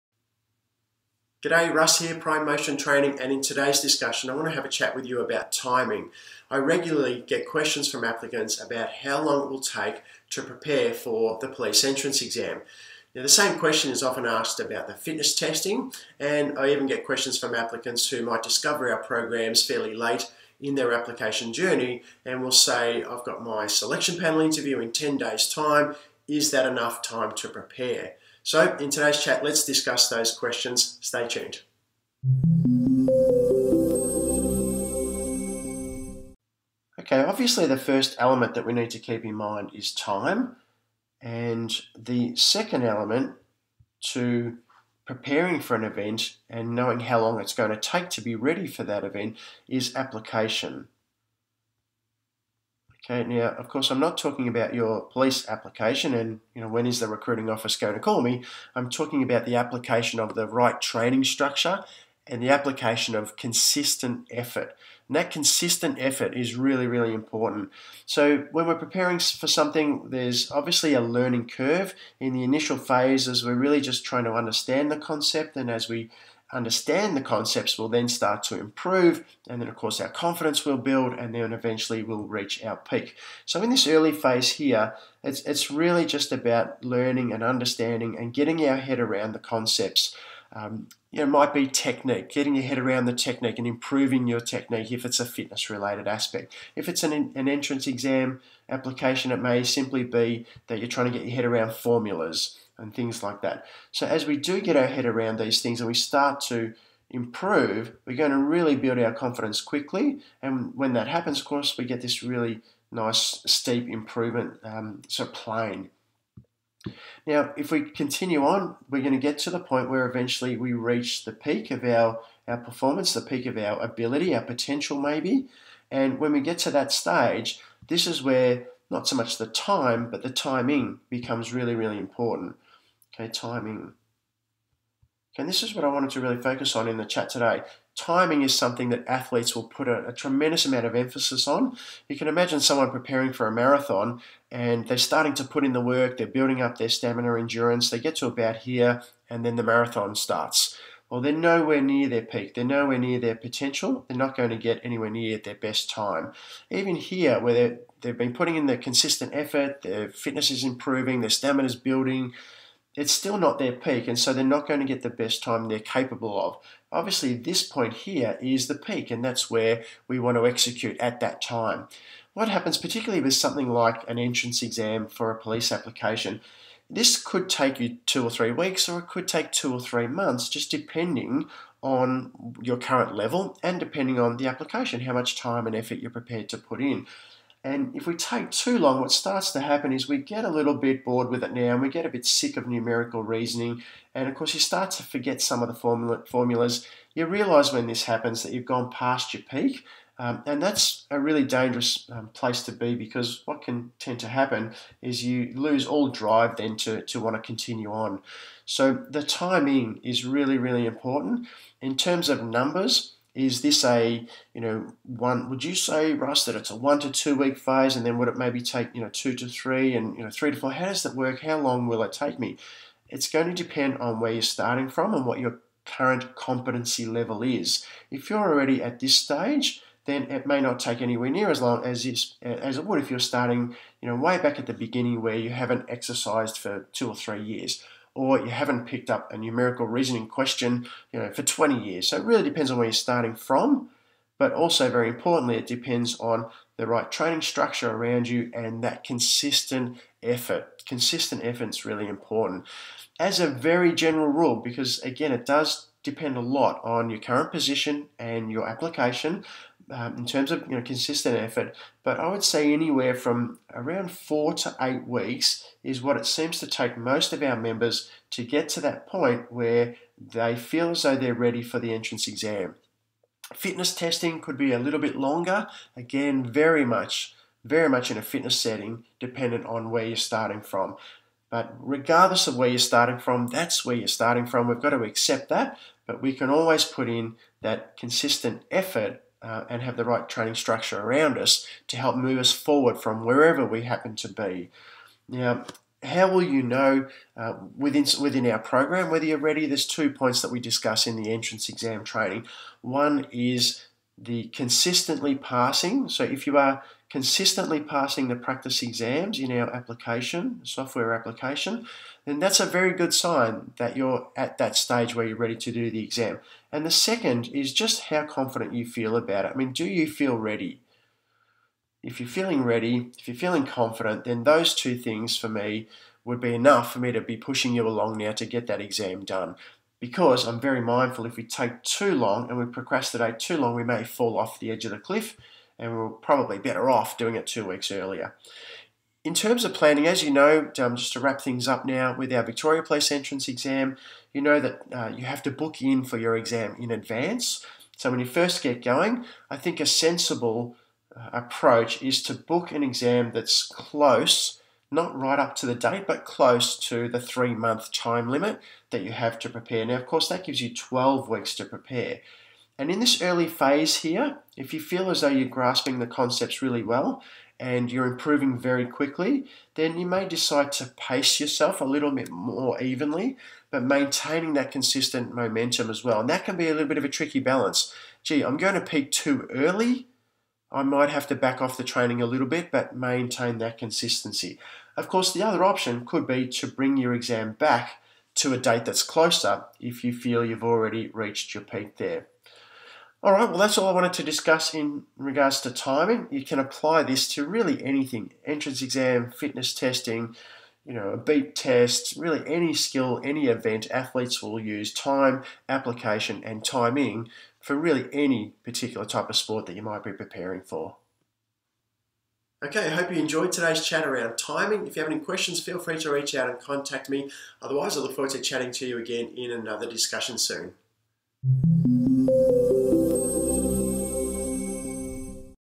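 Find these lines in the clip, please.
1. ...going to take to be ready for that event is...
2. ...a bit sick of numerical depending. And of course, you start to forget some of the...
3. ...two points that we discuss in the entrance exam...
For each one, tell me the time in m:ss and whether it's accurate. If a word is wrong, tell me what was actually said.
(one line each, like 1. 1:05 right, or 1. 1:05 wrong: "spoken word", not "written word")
1. 0:47 right
2. 3:12 wrong: "reasoning", not "depending"
3. 4:59 right.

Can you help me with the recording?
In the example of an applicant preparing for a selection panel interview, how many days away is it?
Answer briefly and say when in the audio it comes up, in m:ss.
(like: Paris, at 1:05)
10 days, at 0:24.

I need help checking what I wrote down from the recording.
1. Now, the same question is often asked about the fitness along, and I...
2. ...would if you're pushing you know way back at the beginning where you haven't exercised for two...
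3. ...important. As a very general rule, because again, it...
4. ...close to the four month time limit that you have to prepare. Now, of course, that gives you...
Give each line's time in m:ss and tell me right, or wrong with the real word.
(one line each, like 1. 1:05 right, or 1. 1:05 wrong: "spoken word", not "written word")
1. 0:13 wrong: "testing", not "along"
2. 3:52 wrong: "starting", not "pushing"
3. 4:12 right
4. 5:56 wrong: "three", not "four".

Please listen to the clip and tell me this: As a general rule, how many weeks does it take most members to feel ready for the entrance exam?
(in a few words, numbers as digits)
4 to 8 weeks.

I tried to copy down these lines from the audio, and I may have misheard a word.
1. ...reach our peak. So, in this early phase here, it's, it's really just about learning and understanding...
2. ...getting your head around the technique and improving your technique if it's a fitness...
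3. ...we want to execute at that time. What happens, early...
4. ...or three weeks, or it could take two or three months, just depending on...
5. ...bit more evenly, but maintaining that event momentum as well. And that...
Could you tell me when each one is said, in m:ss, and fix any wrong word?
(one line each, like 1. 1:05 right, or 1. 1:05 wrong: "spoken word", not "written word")
1. 1:22 right
2. 1:32 right
3. 2:50 wrong: "particularly", not "early"
4. 2:58 right
5. 6:12 wrong: "consistent", not "event".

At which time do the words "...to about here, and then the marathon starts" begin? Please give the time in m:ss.
2:28.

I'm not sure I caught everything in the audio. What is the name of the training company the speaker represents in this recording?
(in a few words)
Prime Motion Training.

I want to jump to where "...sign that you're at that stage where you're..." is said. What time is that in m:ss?
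5:13.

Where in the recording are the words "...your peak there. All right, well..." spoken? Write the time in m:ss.
6:31.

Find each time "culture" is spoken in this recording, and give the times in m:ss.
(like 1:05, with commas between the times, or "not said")
not said.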